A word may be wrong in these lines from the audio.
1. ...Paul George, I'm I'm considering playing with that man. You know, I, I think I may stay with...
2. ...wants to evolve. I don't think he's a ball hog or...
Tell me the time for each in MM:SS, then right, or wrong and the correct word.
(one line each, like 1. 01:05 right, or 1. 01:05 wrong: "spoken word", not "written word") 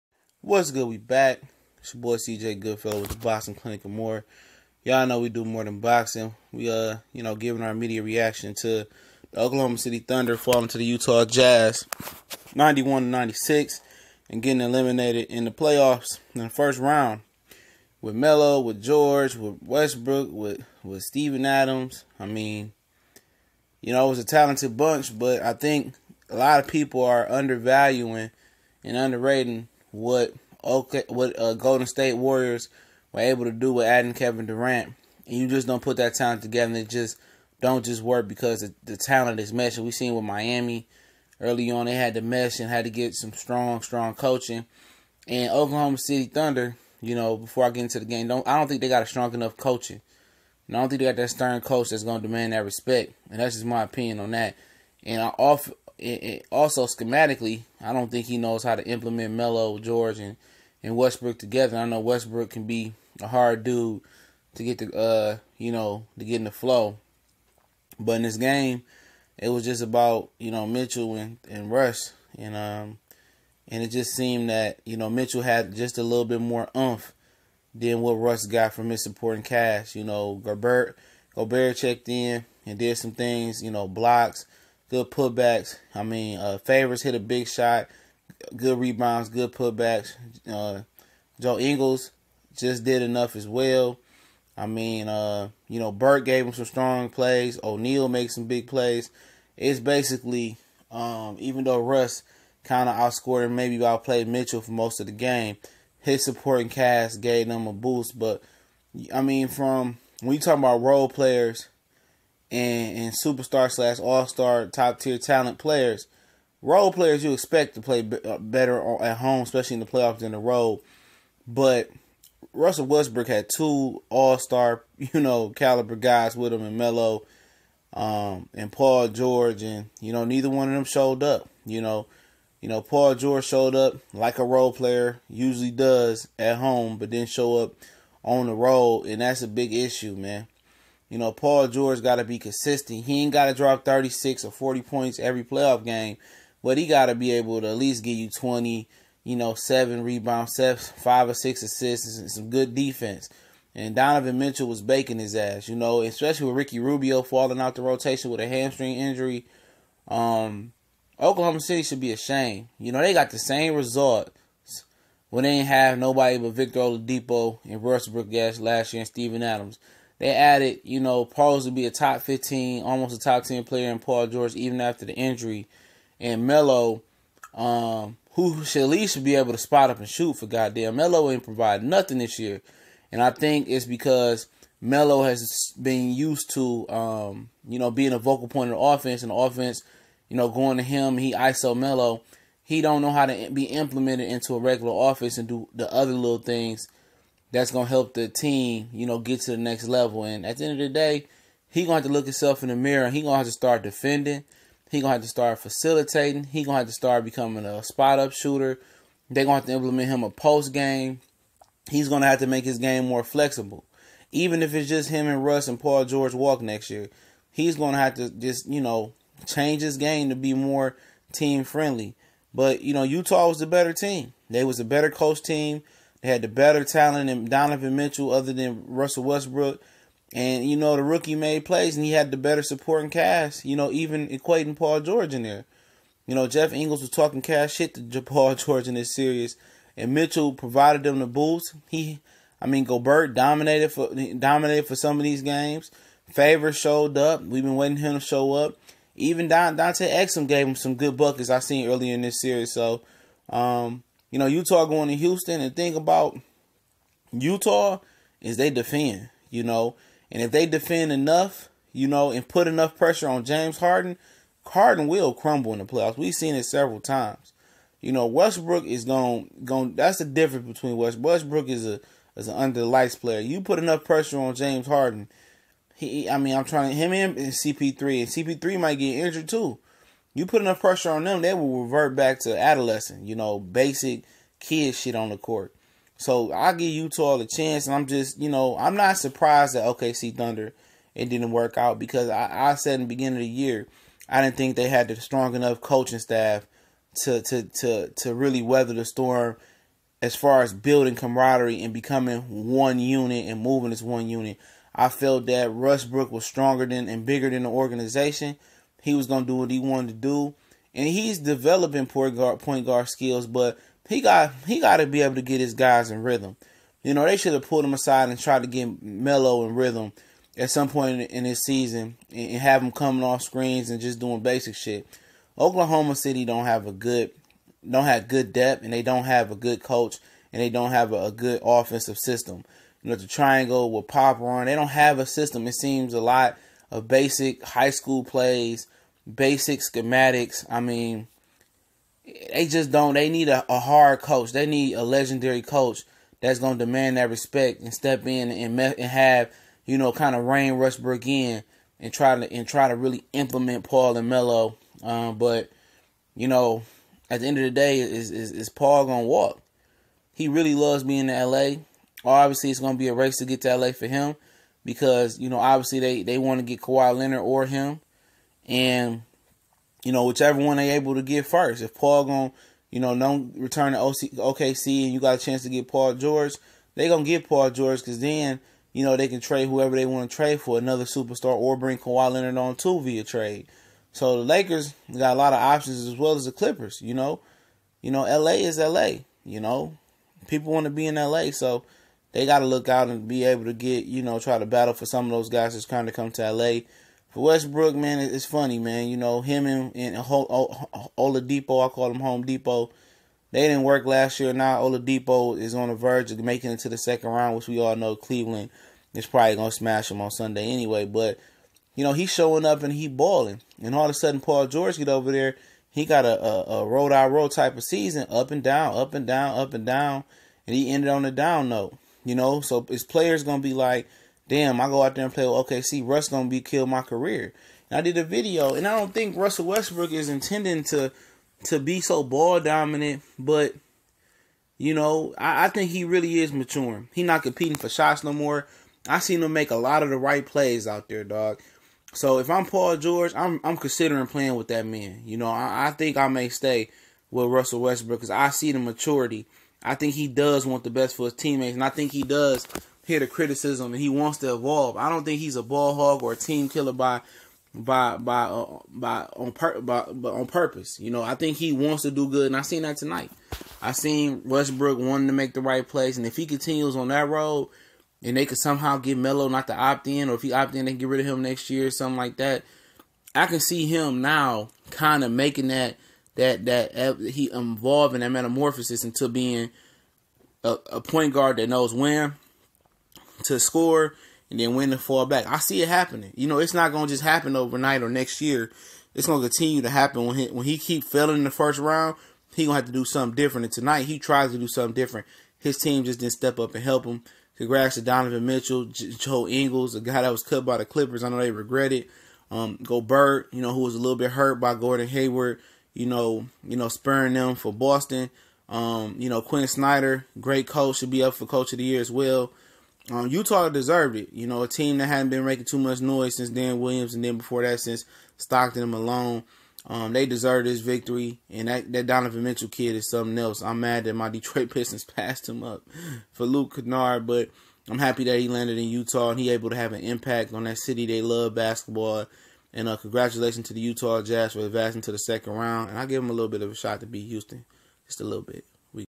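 1. 07:22 right
2. 07:34 right.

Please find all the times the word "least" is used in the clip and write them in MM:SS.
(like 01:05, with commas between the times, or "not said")
02:27, 02:58.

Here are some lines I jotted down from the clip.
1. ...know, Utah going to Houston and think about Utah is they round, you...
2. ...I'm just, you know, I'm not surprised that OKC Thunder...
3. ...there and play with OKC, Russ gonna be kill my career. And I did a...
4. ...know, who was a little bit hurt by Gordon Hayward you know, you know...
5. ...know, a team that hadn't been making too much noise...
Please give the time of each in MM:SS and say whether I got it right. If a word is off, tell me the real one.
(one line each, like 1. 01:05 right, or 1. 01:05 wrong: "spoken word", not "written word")
1. 04:14 wrong: "defend", not "round"
2. 04:47 right
3. 07:05 right
4. 08:23 right
5. 08:34 right.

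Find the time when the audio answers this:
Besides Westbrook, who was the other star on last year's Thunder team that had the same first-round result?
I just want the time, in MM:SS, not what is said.
02:46.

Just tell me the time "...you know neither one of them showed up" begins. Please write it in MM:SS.
02:10.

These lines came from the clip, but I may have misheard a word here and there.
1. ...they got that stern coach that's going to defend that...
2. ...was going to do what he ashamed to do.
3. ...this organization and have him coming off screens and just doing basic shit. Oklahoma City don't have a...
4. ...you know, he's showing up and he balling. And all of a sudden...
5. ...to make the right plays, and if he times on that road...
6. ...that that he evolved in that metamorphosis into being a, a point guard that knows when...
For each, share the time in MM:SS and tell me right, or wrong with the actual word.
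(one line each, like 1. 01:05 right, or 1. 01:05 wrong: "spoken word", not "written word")
1. 00:50 wrong: "demand", not "defend"
2. 05:09 wrong: "wanted", not "ashamed"
3. 05:21 wrong: "season", not "organization"
4. 06:51 right
5. 07:45 wrong: "continues", not "times"
6. 07:56 right.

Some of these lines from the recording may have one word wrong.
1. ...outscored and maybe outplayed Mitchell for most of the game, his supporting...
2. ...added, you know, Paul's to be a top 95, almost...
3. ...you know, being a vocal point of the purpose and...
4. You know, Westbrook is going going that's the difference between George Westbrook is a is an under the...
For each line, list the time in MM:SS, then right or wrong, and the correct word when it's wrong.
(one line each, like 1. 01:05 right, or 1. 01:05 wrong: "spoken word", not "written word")
1. 01:42 right
2. 02:50 wrong: "15", not "95"
3. 03:07 wrong: "offense", not "purpose"
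4. 04:27 wrong: "West", not "George".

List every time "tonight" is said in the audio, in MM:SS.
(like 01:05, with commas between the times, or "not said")
07:42, 08:13.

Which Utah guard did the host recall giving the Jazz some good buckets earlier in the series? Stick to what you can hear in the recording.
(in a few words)
Dante Exum.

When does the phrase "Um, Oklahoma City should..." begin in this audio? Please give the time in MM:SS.
02:40.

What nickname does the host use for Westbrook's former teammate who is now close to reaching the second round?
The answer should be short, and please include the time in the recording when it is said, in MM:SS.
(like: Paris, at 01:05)
Home Depot, at 06:42.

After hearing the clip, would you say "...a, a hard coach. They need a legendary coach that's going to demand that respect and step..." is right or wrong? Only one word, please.
right.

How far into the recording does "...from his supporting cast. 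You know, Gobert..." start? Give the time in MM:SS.
01:18.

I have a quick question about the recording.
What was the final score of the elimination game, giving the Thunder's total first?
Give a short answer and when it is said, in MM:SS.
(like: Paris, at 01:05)
91 to 96, at 00:12.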